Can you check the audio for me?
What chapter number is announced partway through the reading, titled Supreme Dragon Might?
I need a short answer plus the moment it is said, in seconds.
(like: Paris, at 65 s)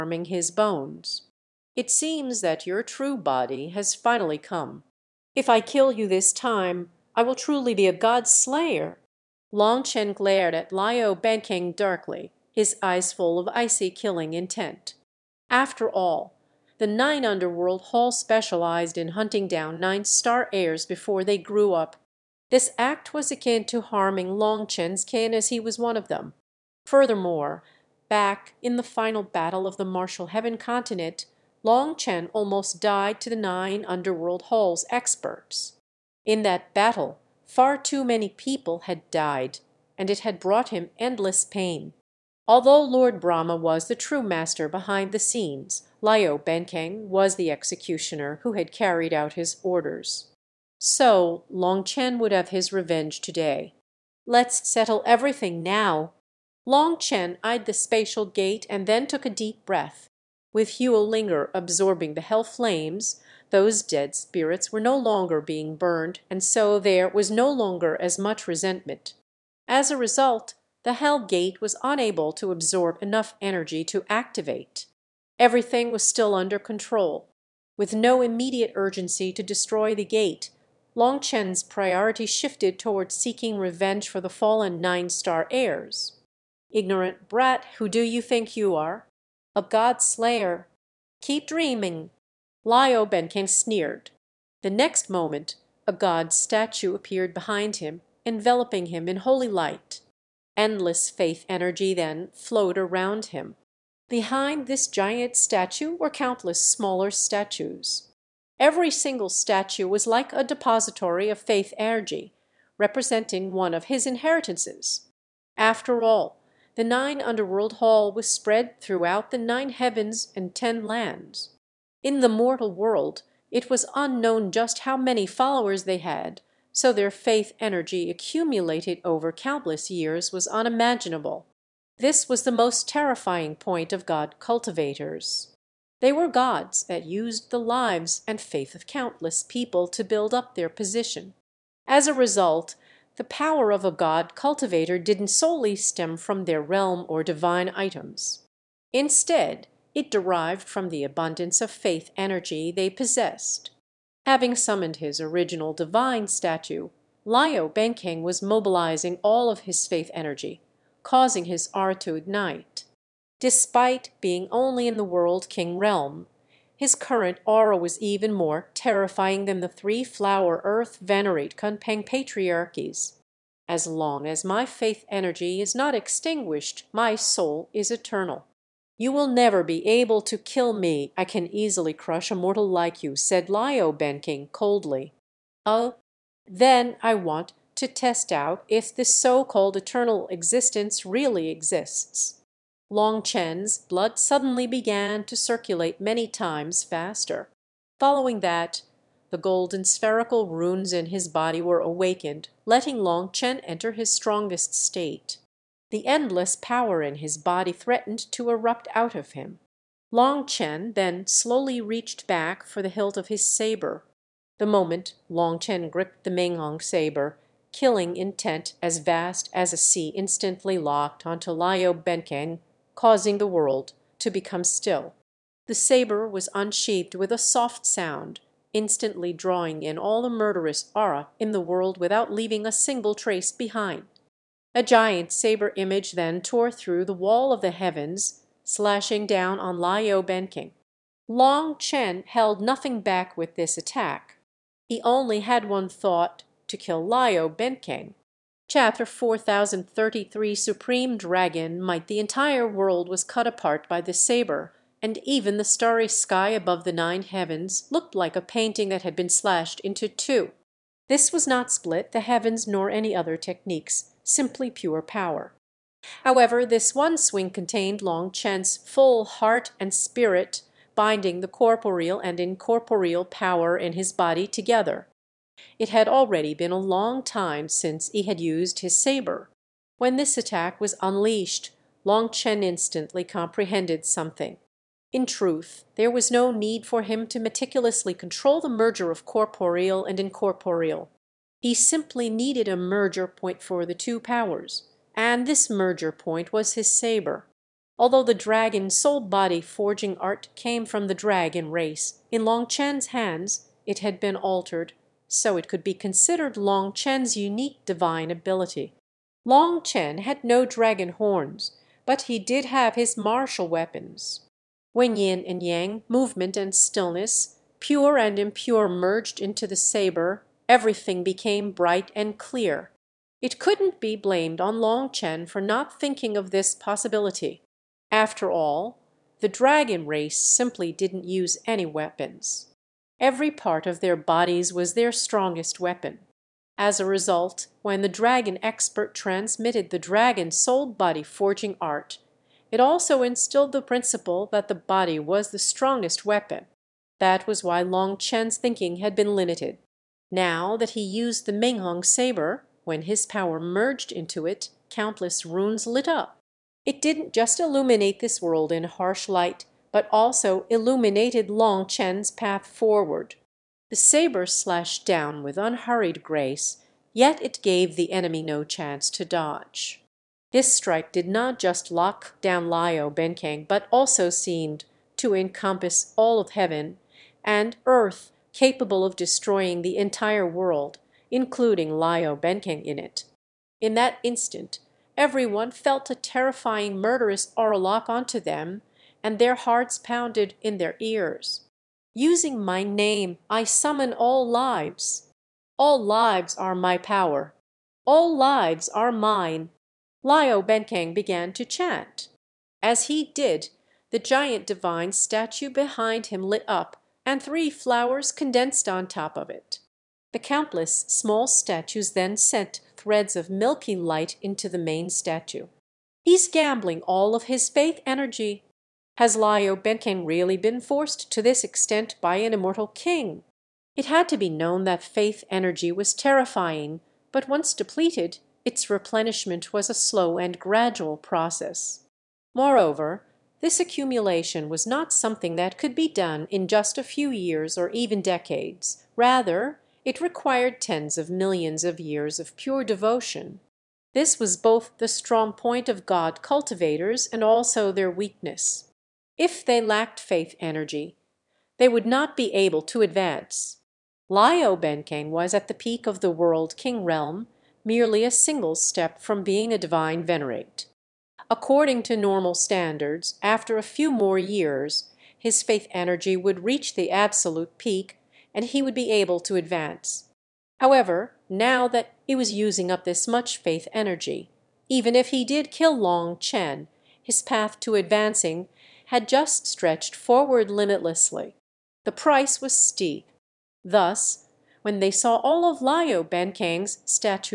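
4033, at 249 s.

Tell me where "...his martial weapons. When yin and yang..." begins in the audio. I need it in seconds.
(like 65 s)
312 s.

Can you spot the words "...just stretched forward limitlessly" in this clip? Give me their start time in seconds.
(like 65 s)
479 s.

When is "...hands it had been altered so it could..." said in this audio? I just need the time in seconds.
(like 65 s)
303 s.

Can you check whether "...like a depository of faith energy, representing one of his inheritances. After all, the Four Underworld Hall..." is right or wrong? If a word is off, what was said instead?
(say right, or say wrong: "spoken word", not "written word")
wrong: "Nine", not "Four".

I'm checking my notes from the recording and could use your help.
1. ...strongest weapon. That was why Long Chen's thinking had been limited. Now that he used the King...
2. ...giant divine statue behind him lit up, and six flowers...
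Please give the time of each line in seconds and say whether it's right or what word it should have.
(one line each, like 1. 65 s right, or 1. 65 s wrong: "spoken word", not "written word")
1. 345 s wrong: "Menghong", not "King"
2. 404 s wrong: "three", not "six".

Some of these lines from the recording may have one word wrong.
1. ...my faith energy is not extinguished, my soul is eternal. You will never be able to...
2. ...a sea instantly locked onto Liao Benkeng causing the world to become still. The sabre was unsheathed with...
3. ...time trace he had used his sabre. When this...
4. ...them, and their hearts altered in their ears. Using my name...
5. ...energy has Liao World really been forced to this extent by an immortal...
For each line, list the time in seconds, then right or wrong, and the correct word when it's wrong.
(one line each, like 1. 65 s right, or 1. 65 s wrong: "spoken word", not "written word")
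1. 174 s right
2. 219 s right
3. 277 s wrong: "since", not "trace"
4. 388 s wrong: "pounded", not "altered"
5. 418 s wrong: "Benkeng", not "World".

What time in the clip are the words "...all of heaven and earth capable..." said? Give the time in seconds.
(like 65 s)
376 s.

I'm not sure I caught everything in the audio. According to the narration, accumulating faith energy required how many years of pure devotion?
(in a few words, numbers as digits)
Tens of millions.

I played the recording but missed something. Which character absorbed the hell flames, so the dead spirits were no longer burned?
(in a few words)
Ling'er.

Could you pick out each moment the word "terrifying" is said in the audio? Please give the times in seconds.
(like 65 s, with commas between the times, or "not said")
132 s, 168 s, 386 s, 426 s.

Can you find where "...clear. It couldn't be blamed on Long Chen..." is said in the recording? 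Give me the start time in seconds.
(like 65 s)
322 s.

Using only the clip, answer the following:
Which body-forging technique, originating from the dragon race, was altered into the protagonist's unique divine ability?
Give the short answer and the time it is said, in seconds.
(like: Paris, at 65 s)
Dragon soul body forging art, at 298 s.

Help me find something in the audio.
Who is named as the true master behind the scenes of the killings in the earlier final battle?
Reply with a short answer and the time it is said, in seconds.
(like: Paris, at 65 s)
Lord Brahma, at 42 s.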